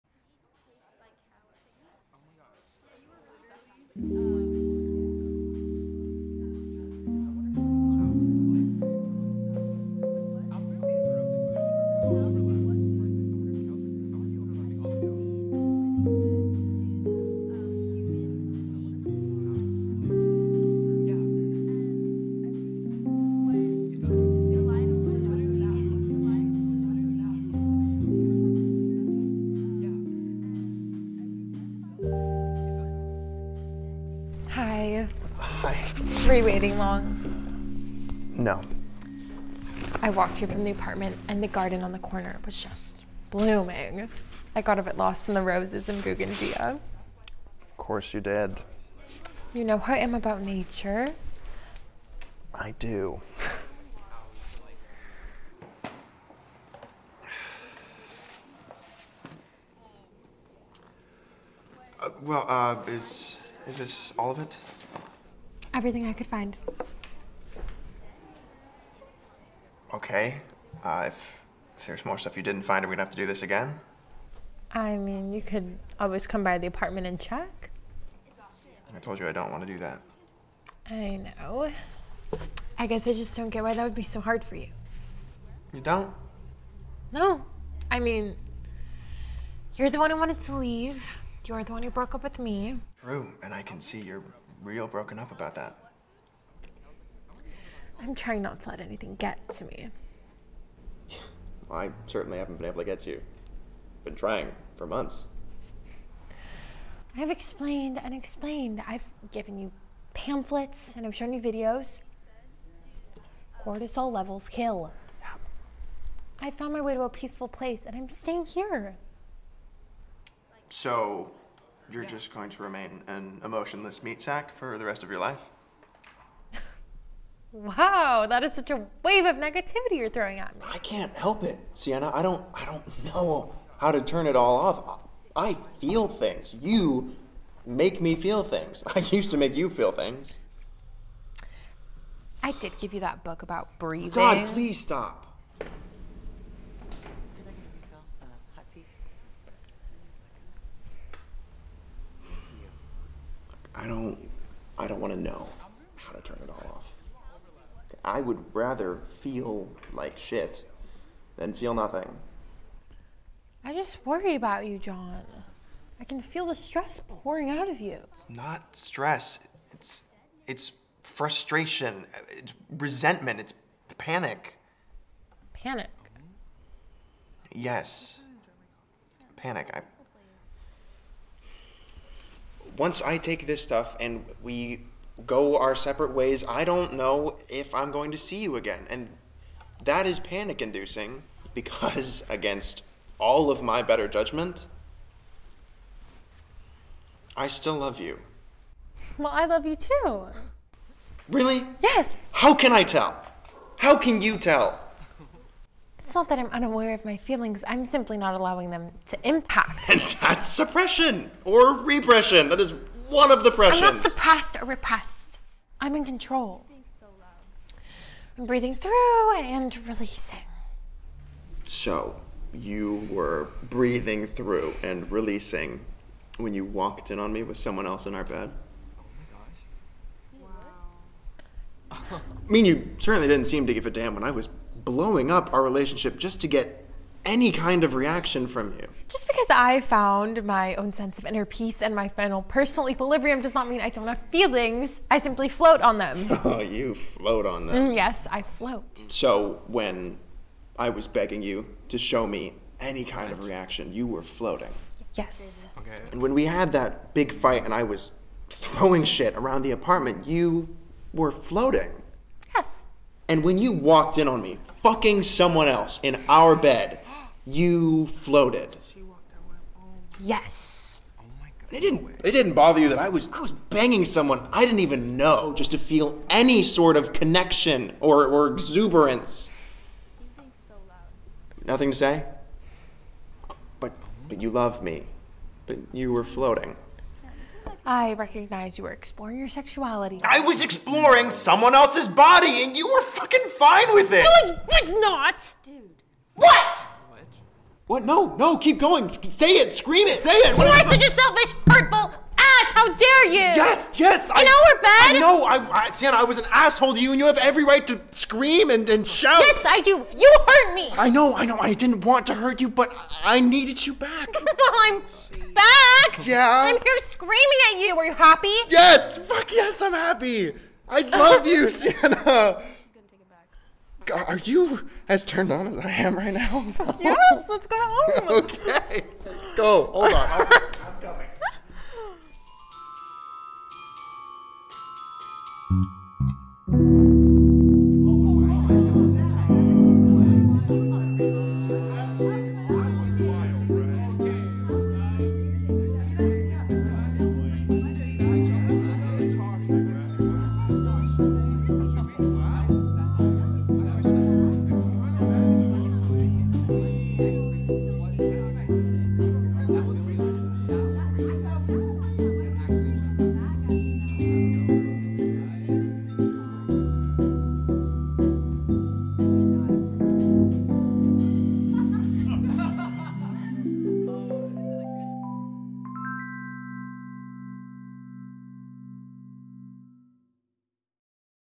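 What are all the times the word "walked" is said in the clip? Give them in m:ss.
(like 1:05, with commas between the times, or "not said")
0:40, 3:46, 4:23.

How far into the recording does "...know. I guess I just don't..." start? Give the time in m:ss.
1:21.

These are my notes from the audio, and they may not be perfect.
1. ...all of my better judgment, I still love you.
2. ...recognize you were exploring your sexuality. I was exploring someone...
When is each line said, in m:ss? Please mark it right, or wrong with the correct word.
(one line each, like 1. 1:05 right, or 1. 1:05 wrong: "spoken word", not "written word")
1. 3:13 right
2. 4:48 right.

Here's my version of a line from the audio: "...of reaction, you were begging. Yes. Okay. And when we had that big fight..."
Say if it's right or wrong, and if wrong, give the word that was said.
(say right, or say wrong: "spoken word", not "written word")
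wrong: "floating", not "begging".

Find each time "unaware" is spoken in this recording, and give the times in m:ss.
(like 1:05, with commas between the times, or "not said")
3:26.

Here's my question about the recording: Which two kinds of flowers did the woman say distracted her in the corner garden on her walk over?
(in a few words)
roses and bougainvillea.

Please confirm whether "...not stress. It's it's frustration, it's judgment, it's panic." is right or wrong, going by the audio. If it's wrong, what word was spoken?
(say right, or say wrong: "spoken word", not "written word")
wrong: "resentment", not "judgment".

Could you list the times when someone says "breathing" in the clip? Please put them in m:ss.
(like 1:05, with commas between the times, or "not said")
2:23, 3:38, 3:43.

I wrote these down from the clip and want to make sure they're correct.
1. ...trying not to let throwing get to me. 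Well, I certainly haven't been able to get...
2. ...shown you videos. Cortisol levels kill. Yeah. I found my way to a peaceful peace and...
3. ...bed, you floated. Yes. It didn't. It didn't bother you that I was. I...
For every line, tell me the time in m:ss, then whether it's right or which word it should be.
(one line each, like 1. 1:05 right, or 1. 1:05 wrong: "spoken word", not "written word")
1. 1:38 wrong: "anything", not "throwing"
2. 1:51 wrong: "place", not "peace"
3. 4:26 right.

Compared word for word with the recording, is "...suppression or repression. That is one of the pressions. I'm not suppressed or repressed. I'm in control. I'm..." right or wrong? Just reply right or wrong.
right.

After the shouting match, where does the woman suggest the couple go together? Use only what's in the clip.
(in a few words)
home.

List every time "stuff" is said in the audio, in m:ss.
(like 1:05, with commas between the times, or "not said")
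1:12, 3:03.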